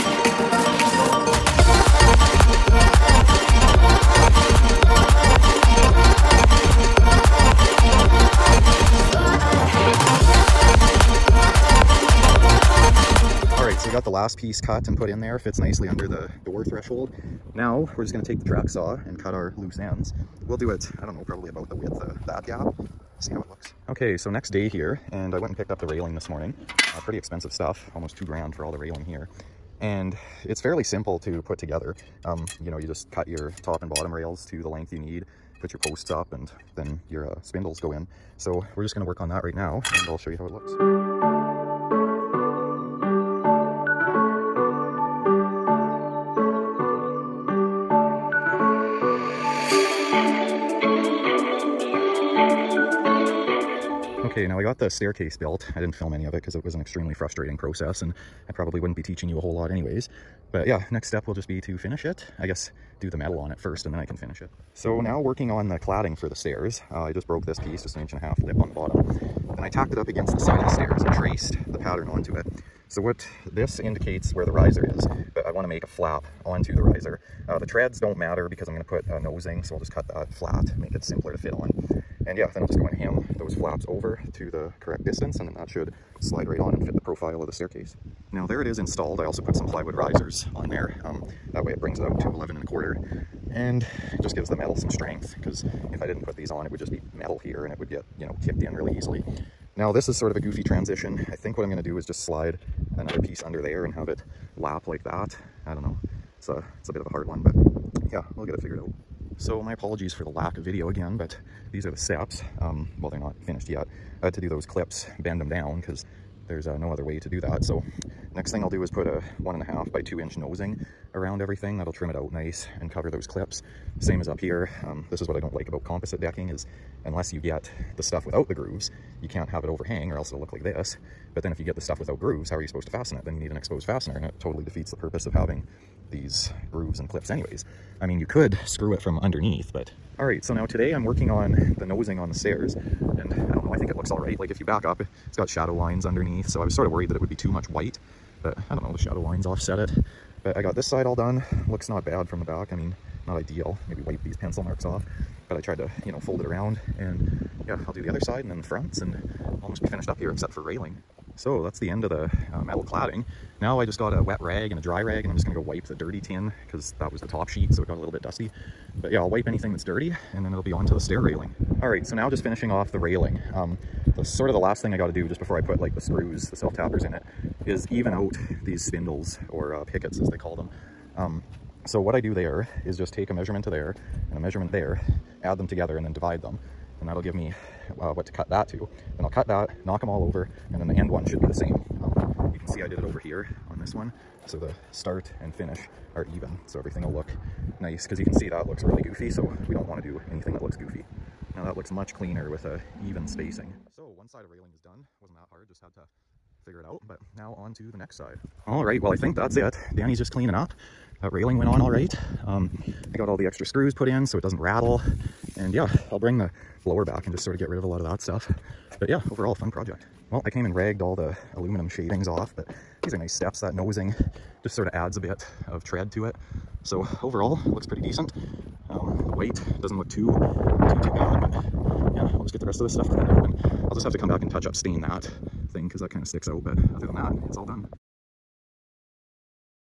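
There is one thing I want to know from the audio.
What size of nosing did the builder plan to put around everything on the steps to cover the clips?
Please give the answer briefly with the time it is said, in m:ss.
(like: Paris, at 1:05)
1.5 by 2 inch, at 1:59.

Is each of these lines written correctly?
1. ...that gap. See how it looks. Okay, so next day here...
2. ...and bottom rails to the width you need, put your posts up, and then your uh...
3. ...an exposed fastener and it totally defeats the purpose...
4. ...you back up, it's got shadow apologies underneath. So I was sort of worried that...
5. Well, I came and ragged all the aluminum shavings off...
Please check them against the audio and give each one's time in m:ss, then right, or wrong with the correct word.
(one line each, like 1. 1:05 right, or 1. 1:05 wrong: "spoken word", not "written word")
1. 0:22 right
2. 0:33 wrong: "length", not "width"
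3. 2:13 right
4. 2:24 wrong: "lines", not "apologies"
5. 3:40 right.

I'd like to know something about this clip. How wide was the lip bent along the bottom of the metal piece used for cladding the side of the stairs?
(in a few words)
1.5 inches.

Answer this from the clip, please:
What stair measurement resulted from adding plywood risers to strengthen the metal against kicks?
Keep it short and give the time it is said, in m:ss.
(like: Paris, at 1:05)
11 1/4, at 1:32.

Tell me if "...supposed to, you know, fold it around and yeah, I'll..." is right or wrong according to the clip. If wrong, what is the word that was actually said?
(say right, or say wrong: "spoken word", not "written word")
wrong: "tried", not "supposed".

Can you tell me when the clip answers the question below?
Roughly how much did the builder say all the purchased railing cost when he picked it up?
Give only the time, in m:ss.
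0:27.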